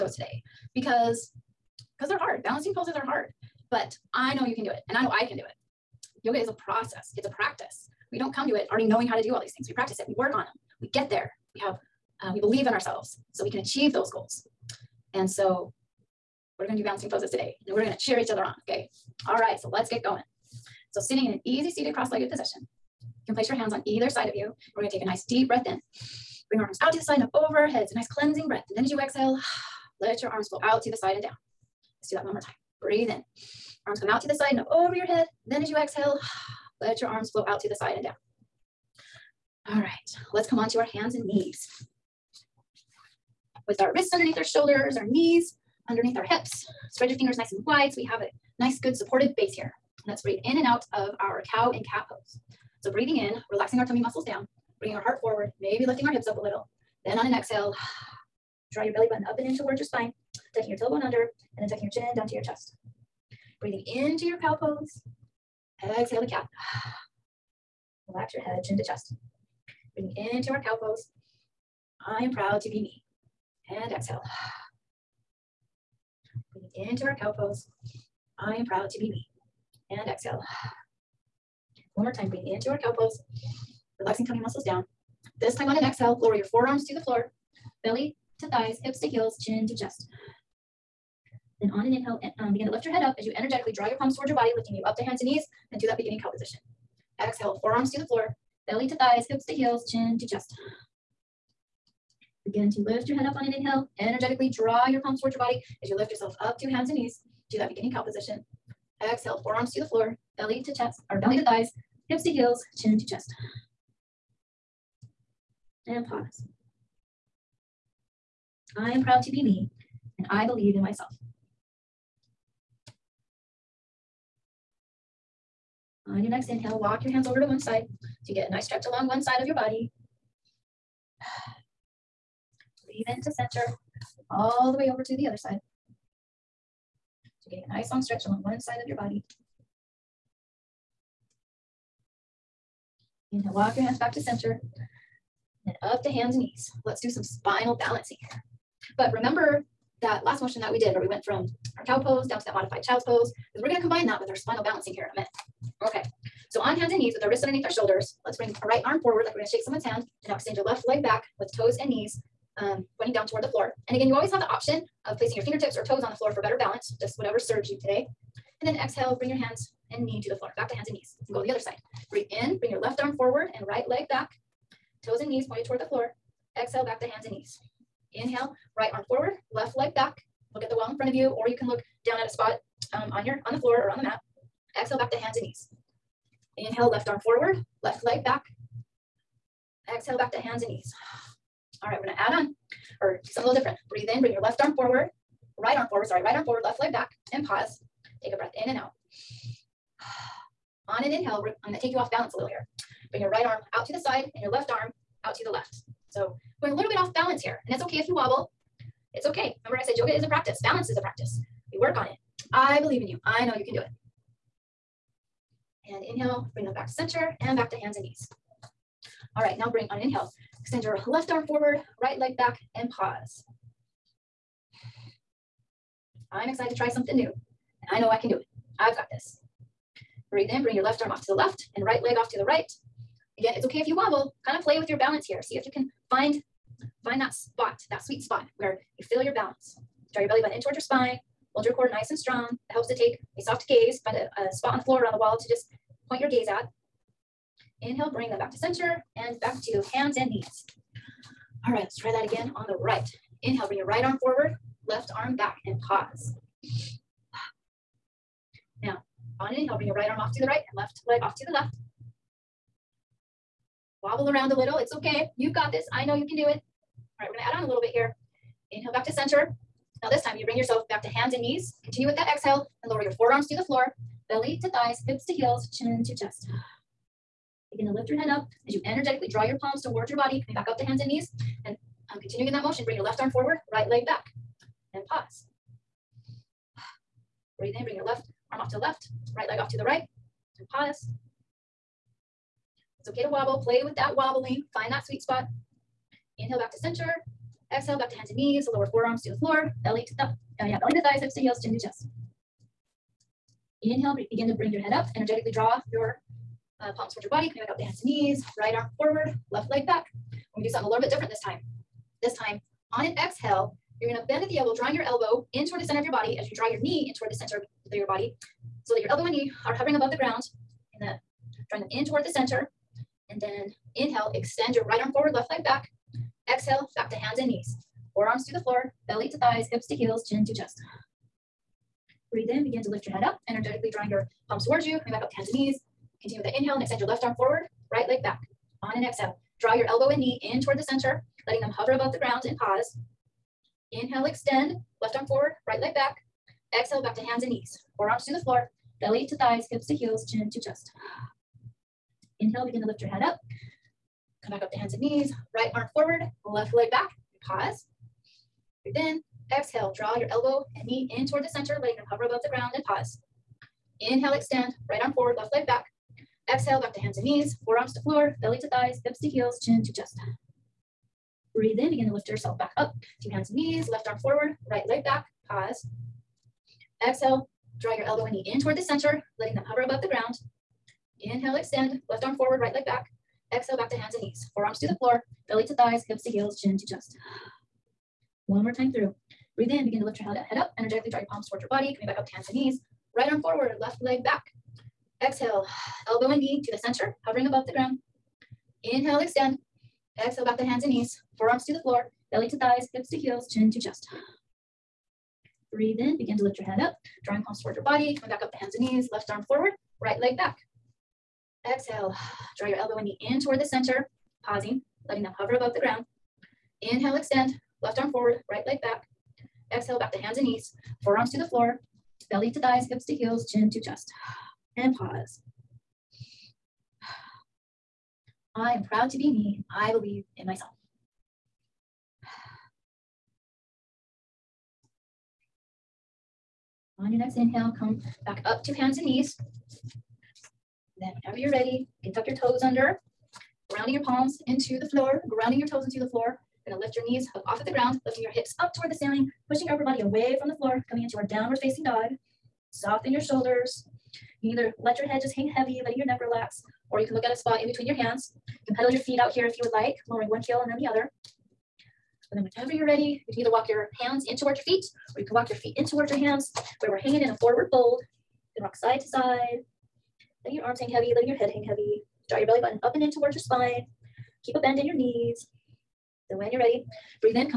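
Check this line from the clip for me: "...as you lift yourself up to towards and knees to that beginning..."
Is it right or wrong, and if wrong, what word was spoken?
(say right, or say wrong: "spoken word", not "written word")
wrong: "hands", not "towards".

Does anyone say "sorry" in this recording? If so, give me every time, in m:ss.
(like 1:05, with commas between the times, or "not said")
3:16.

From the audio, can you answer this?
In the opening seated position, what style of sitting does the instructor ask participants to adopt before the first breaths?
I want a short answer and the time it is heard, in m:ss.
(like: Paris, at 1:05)
Easy seated cross-legged, at 0:21.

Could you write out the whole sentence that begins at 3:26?
So going a little bit off balance here, and it's okay if you wobble.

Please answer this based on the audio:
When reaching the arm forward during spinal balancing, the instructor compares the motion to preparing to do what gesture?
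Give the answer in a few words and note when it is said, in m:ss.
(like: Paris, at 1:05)
Shake someone's hand, at 2:39.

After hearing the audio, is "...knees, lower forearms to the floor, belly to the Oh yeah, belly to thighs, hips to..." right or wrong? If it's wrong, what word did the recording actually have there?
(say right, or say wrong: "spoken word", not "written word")
right.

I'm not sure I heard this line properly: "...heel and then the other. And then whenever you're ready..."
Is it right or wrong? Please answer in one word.
right.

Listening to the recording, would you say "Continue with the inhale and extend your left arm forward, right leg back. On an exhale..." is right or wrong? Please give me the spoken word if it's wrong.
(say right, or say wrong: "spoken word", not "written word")
right.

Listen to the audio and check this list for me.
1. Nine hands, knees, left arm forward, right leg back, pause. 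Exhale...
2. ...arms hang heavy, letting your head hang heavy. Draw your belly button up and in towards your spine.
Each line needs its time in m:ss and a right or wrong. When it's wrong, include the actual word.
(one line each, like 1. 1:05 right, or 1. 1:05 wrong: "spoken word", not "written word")
1. 6:13 wrong: "Two", not "Nine"
2. 7:50 right.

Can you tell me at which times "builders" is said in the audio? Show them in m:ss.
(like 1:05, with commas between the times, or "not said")
not said.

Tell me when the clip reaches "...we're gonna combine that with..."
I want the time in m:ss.
2:33.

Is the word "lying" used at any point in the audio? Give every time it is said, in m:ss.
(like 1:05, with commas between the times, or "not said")
not said.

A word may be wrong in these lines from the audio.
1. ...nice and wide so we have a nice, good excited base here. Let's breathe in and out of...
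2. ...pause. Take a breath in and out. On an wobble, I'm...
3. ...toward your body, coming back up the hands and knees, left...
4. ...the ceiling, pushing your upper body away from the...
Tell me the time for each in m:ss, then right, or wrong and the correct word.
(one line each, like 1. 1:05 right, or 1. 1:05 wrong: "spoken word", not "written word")
1. 0:47 wrong: "supported", not "excited"
2. 3:17 wrong: "inhale", not "wobble"
3. 6:47 right
4. 7:28 right.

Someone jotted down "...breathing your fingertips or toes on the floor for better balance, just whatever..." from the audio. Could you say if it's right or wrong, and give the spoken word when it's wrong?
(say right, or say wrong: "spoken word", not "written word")
wrong: "placing", not "breathing".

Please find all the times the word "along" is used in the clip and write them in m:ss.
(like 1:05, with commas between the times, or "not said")
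2:08, 2:18.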